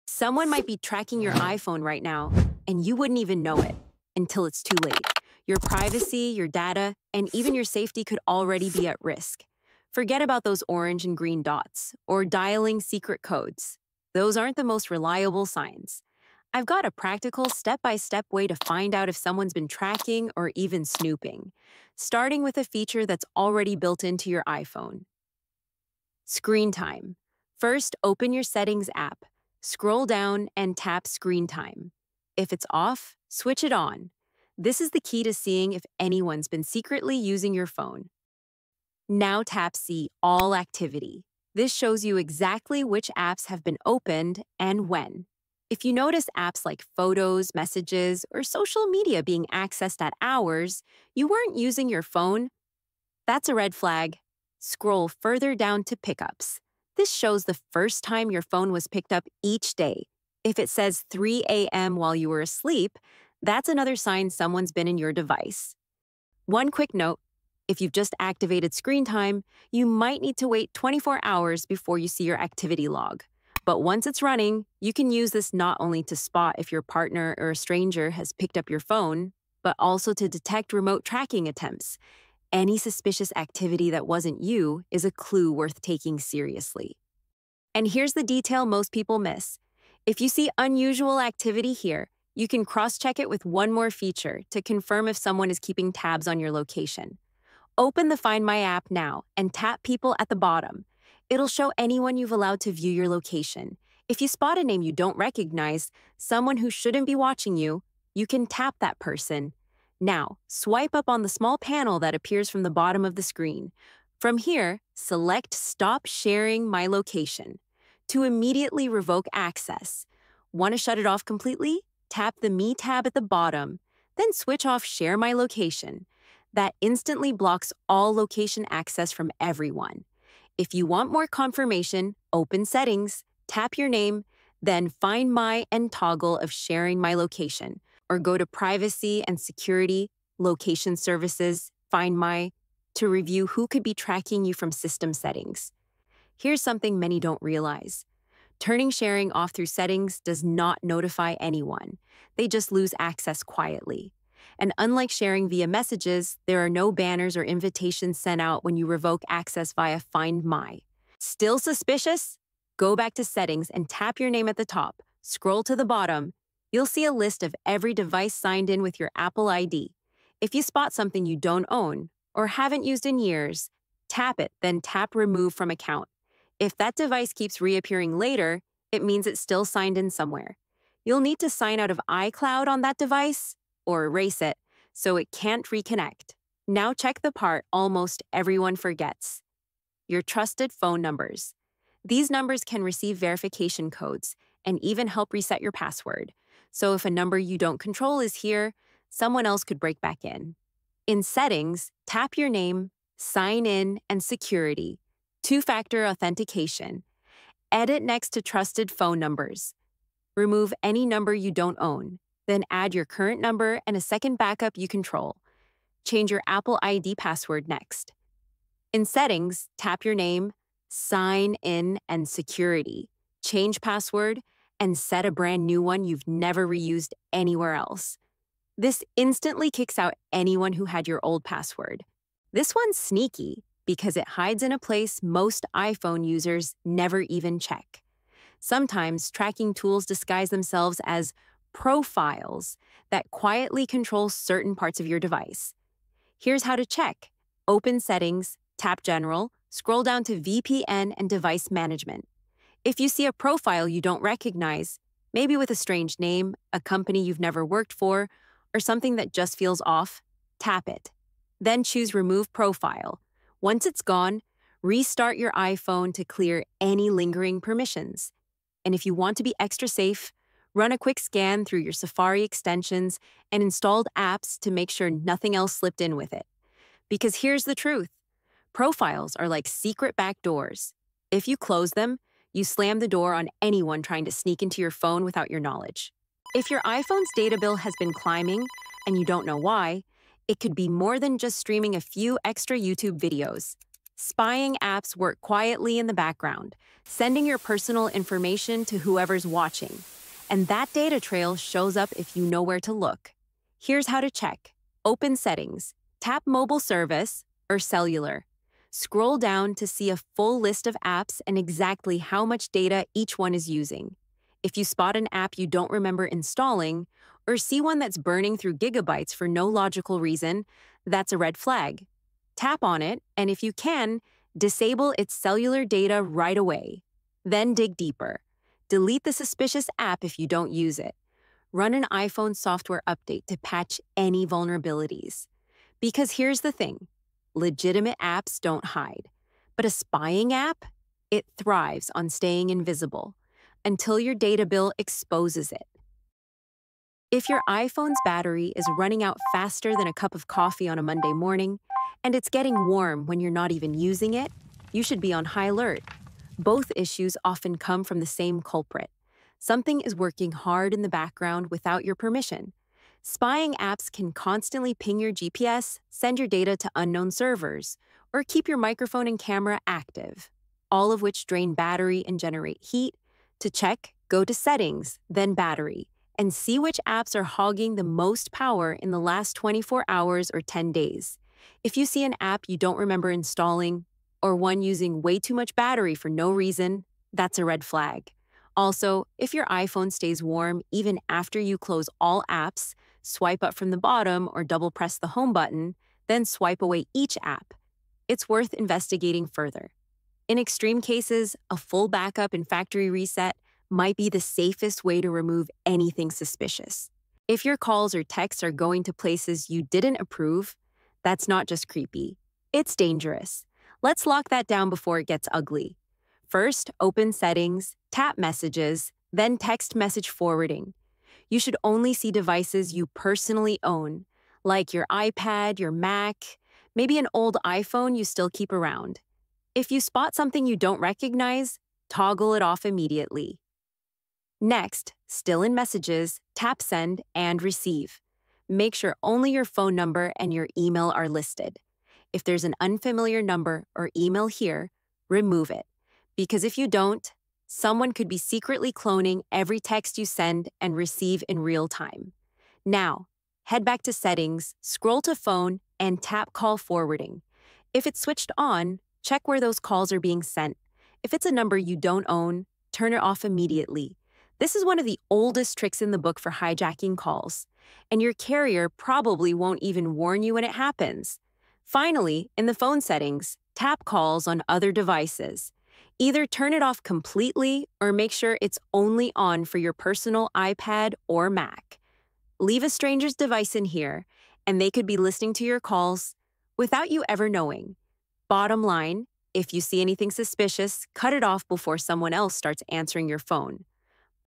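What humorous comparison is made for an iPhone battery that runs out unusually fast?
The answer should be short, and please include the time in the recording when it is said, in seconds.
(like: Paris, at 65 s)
a cup of coffee, at 350 s.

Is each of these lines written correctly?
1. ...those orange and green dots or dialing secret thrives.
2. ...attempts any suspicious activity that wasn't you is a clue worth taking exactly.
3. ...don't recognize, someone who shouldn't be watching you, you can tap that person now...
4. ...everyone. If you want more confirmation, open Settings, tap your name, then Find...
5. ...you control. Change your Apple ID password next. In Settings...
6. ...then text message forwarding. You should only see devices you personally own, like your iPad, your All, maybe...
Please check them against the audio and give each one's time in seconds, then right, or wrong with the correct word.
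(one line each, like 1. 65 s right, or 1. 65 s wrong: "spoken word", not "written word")
1. 10 s wrong: "codes", not "thrives"
2. 81 s wrong: "seriously", not "exactly"
3. 104 s right
4. 129 s right
5. 214 s right
6. 419 s wrong: "Mac", not "All".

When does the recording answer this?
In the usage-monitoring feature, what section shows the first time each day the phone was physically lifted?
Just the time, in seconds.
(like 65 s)
55 s.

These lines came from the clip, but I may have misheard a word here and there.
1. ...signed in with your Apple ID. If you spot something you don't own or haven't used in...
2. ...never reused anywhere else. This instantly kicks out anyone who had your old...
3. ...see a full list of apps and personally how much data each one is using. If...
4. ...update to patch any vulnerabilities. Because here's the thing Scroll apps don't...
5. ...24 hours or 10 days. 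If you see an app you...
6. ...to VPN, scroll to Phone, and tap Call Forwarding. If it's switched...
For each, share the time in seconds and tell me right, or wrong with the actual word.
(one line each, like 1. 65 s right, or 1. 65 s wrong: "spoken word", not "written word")
1. 168 s right
2. 226 s right
3. 309 s wrong: "exactly", not "personally"
4. 333 s wrong: "Legitimate", not "Scroll"
5. 379 s right
6. 454 s wrong: "Settings", not "VPN".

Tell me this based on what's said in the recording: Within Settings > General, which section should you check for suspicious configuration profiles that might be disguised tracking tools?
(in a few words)
VPN and Device Management.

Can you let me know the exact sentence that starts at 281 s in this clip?
If you close them, you slam the door on anyone trying to sneak into your phone without your knowledge.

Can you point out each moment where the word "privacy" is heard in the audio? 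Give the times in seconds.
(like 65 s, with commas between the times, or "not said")
5 s, 138 s.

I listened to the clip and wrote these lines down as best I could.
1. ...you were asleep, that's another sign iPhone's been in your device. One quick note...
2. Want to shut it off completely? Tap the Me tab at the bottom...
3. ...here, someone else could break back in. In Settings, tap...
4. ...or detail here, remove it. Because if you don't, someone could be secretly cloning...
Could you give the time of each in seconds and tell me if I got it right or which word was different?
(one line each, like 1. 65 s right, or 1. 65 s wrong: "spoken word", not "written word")
1. 62 s wrong: "someone", not "iPhone"
2. 120 s right
3. 198 s right
4. 443 s wrong: "email", not "detail".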